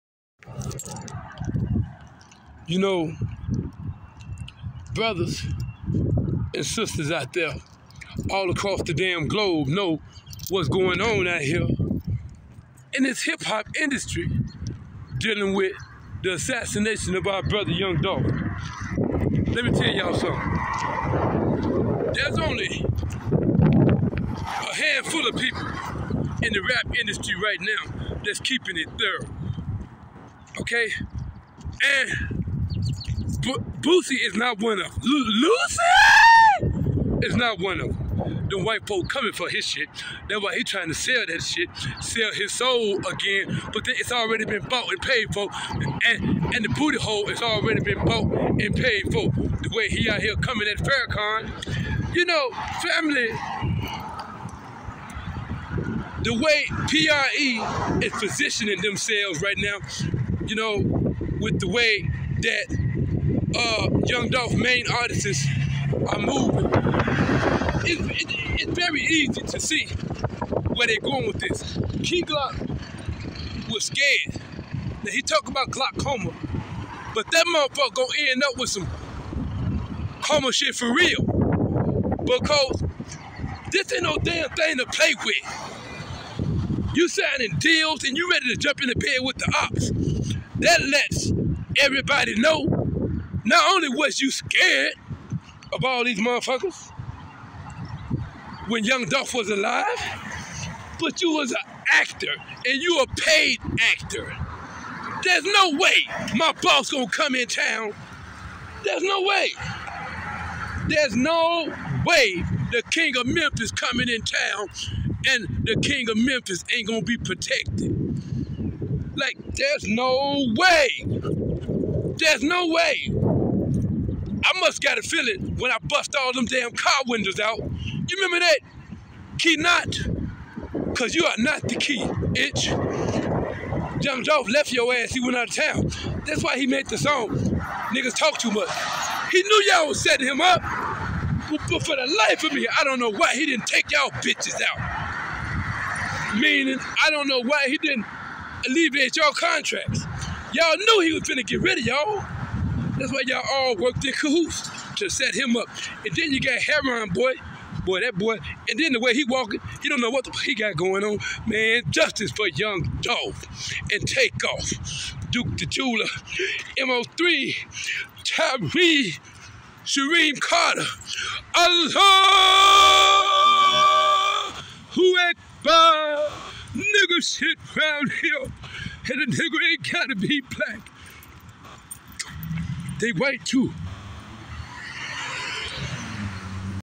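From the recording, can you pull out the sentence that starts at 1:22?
Because this ain't no damn thing to play with.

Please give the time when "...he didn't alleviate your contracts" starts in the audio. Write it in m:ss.
2:27.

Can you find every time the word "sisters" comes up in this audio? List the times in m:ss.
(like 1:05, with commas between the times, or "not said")
0:06.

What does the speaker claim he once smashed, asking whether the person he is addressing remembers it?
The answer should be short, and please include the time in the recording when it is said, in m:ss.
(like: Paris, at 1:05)
car windows, at 2:06.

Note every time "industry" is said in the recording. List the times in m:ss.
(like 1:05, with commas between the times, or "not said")
0:13, 0:26.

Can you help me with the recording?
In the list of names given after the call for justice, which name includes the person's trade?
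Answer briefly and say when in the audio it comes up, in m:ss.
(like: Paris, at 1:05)
Duke the Jeweler, at 2:45.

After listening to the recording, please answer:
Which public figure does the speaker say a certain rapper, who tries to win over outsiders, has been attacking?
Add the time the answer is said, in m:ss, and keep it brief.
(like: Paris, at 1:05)
Farrakhan, at 0:50.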